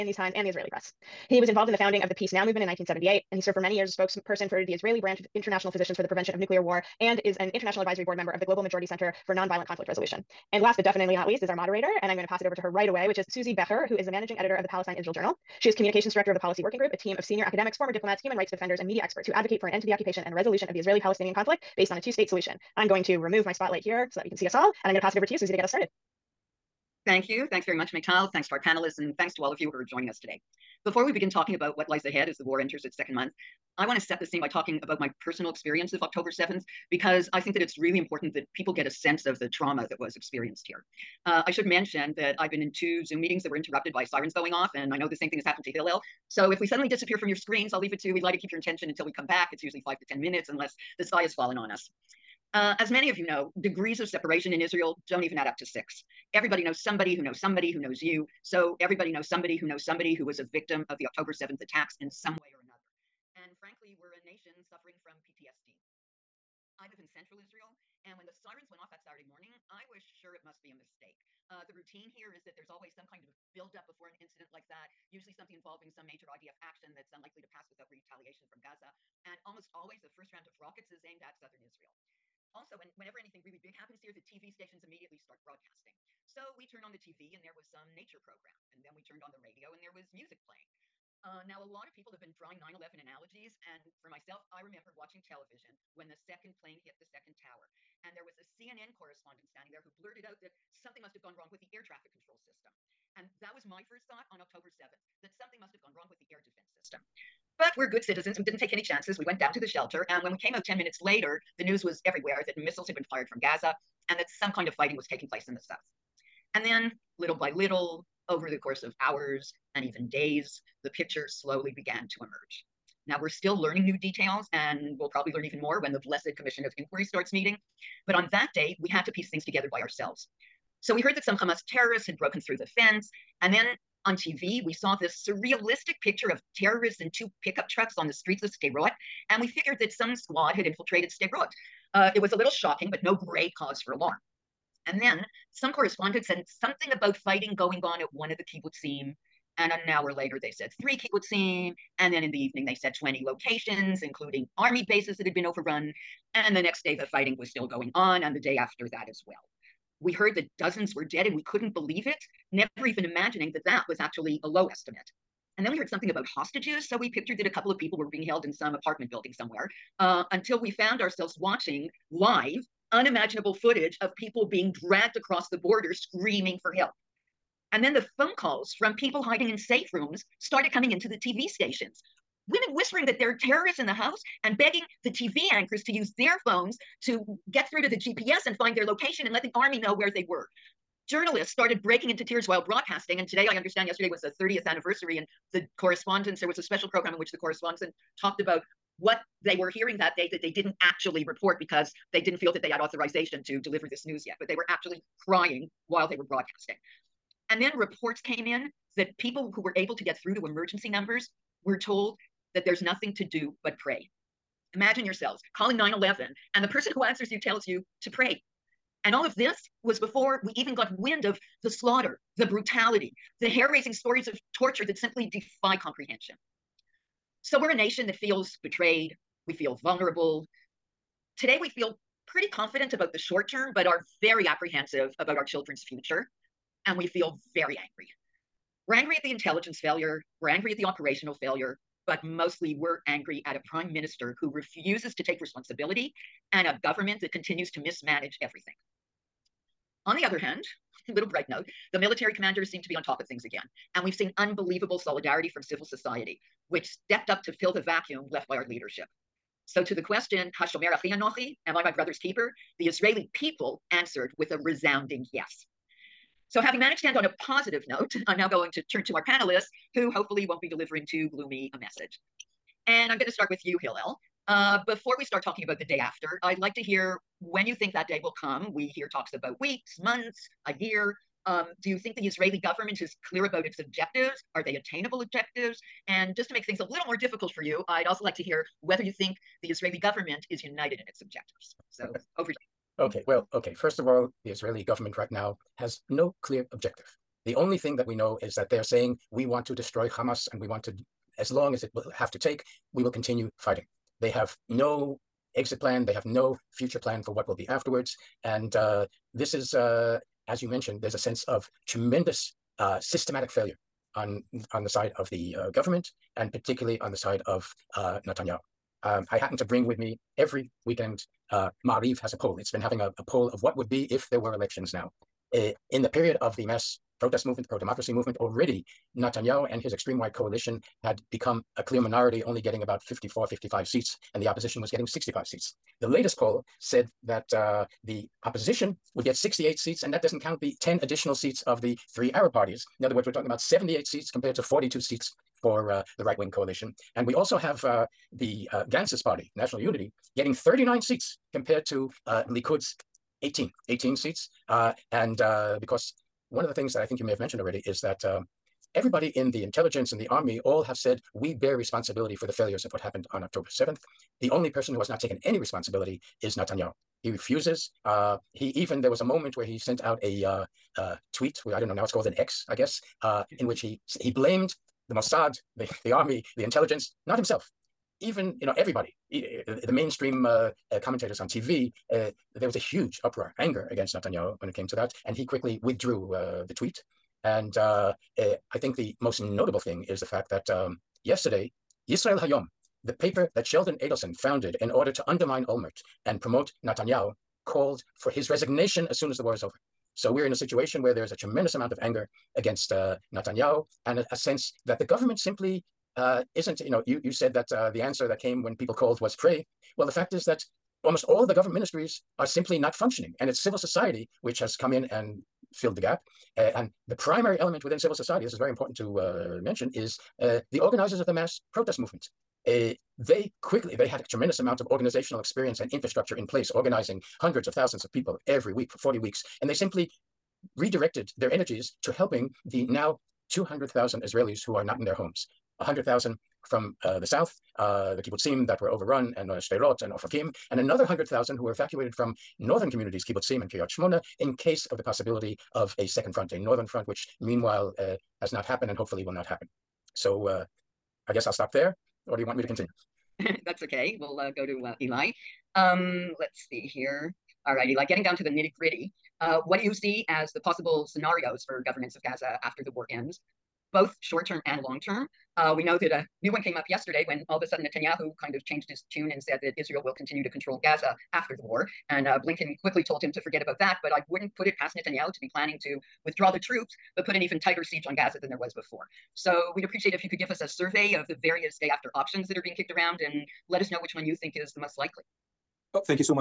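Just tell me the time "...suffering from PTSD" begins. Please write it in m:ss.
1:04.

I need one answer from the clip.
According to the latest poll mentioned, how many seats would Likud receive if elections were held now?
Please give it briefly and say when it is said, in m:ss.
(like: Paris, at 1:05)
18, at 5:53.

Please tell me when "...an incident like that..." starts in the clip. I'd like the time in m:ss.
1:14.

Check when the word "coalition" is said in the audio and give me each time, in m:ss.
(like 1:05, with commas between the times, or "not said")
5:30, 5:46.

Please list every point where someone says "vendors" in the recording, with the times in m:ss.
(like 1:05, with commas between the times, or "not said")
not said.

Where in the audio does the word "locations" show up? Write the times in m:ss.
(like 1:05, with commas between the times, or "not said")
2:33, 3:08.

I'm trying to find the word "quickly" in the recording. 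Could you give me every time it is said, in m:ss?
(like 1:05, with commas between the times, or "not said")
6:25, 7:03, 7:52.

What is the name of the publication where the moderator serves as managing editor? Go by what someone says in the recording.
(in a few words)
Palestine Israel Journal.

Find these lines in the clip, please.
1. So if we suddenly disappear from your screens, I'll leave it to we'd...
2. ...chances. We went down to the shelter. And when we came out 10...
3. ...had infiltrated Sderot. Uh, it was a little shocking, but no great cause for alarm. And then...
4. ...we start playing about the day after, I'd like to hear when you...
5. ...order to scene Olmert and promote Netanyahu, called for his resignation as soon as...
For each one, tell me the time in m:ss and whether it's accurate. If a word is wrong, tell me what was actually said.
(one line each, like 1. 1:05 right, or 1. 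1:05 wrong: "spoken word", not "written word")
1. 0:46 right
2. 1:48 right
3. 2:20 right
4. 4:35 wrong: "talking", not "playing"
5. 6:34 wrong: "undermine", not "scene".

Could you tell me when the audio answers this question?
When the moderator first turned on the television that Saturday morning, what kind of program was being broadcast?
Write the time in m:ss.
1:27.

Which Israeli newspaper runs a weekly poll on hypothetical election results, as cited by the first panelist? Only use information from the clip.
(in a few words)
Ma'ariv.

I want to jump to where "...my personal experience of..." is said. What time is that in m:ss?
0:34.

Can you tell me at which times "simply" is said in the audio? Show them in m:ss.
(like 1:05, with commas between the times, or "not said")
3:44, 6:45, 6:52, 7:09.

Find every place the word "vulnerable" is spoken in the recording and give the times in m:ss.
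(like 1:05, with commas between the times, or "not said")
3:49.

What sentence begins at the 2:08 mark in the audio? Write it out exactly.
But on that day, we had to piece things together by ourselves.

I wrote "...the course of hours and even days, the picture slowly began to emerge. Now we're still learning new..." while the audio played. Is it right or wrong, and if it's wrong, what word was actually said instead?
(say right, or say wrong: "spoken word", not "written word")
right.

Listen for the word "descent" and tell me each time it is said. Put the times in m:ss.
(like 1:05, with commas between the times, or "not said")
not said.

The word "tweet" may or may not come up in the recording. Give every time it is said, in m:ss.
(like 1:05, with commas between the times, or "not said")
6:11, 6:26.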